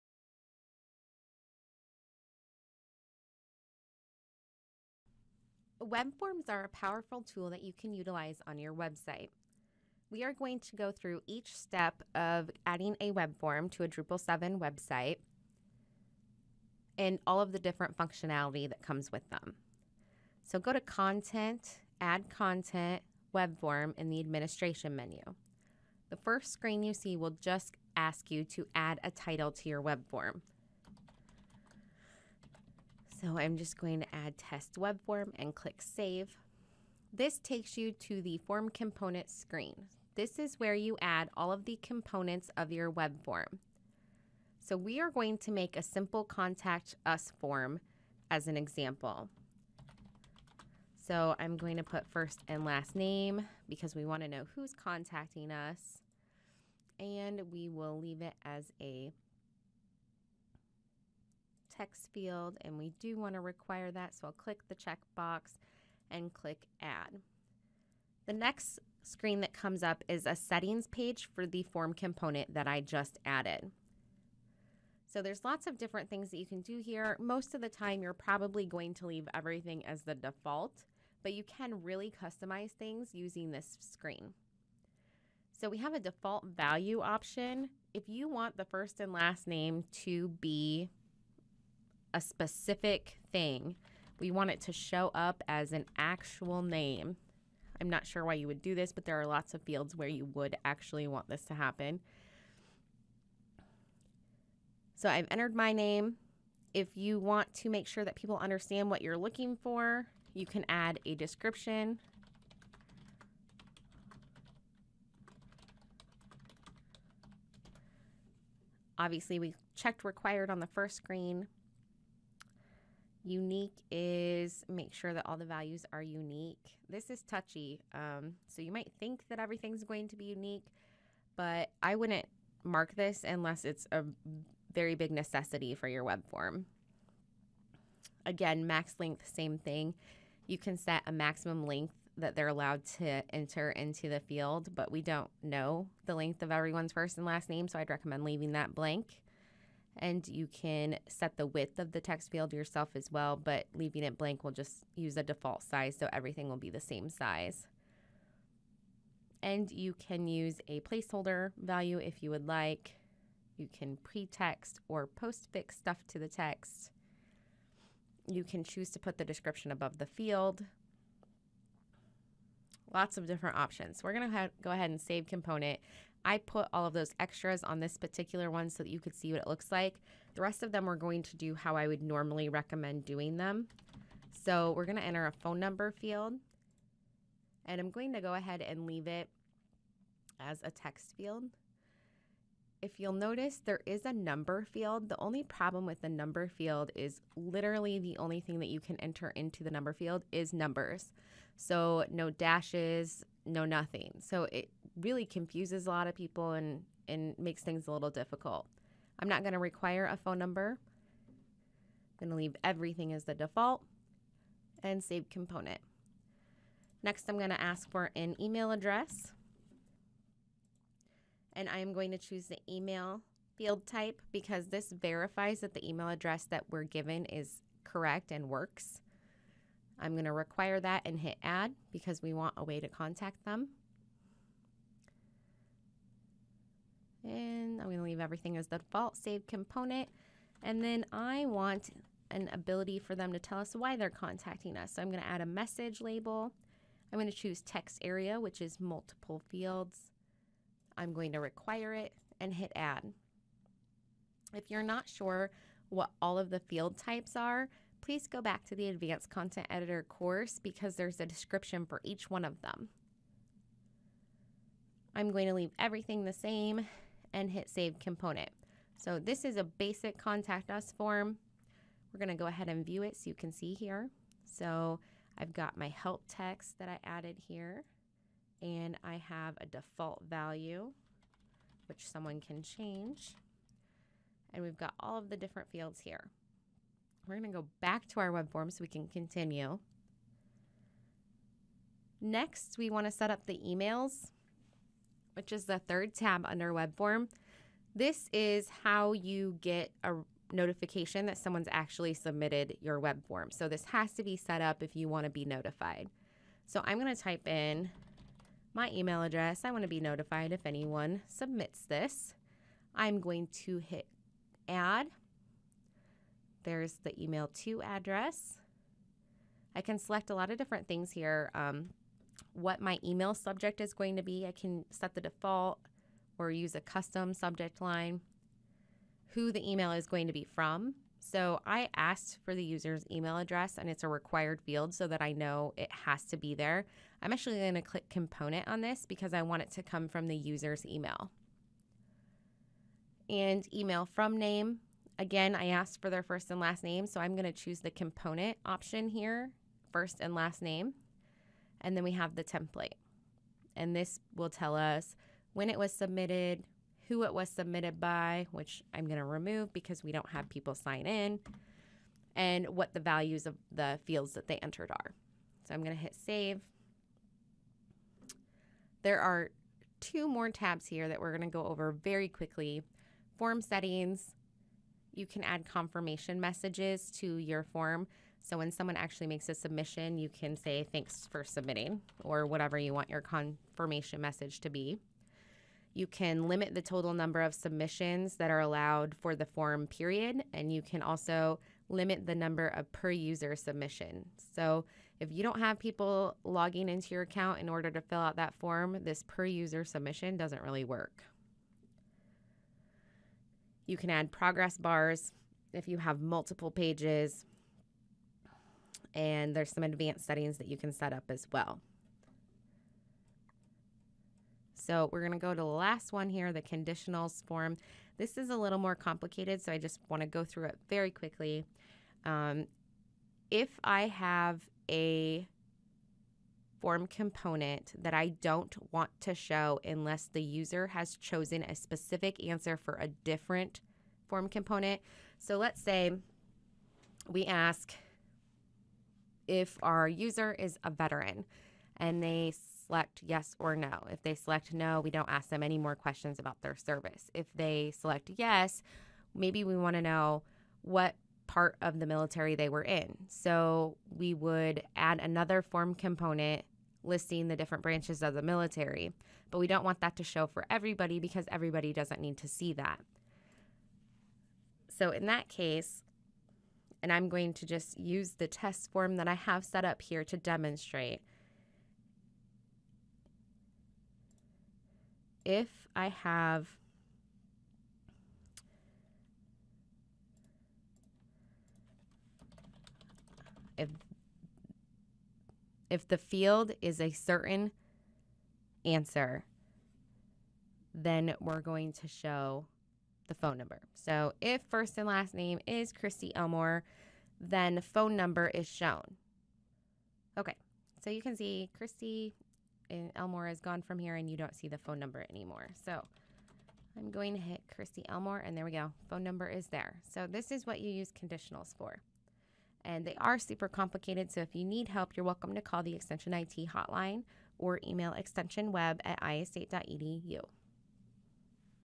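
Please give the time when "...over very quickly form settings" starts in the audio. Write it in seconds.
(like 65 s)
371 s.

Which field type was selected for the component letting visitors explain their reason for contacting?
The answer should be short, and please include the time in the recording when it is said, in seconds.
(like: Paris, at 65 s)
text area, at 247 s.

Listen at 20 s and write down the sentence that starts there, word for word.
So go to Content, Add Content, Web Form in the Administration menu.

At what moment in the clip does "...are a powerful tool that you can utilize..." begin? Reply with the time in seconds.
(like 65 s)
6 s.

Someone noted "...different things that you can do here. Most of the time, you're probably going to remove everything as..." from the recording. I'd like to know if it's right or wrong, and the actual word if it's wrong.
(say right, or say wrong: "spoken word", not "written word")
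wrong: "leave", not "remove".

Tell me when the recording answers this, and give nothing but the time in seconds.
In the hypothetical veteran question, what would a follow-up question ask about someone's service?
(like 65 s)
451 s.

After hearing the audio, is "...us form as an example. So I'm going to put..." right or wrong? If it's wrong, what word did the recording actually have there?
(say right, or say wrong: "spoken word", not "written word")
right.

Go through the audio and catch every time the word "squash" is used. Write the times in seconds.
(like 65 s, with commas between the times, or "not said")
not said.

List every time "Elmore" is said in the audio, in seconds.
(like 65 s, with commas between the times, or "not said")
496 s, 503 s, 508 s.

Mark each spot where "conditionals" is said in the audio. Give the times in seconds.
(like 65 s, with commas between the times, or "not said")
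416 s, 511 s.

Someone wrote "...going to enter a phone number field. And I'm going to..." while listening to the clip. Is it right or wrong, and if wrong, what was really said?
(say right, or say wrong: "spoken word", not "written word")
right.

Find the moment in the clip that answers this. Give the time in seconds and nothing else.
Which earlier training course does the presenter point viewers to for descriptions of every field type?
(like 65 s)
258 s.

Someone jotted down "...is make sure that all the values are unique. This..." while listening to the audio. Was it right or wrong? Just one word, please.
right.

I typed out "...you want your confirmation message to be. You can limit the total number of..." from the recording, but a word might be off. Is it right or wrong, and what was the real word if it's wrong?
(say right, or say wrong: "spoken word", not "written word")
right.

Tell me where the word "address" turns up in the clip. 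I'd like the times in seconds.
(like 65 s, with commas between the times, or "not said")
218 s, 226 s, 309 s, 317 s, 333 s.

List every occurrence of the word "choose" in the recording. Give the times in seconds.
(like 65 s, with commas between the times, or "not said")
168 s, 222 s, 247 s, 347 s.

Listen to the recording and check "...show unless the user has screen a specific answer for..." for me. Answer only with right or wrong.
wrong.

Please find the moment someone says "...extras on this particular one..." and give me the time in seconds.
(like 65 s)
177 s.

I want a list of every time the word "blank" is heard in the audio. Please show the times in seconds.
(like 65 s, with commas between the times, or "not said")
148 s, 154 s.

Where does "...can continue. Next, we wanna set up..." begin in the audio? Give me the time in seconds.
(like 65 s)
288 s.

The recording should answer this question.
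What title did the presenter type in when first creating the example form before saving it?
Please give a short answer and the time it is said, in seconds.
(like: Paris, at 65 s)
test web form, at 34 s.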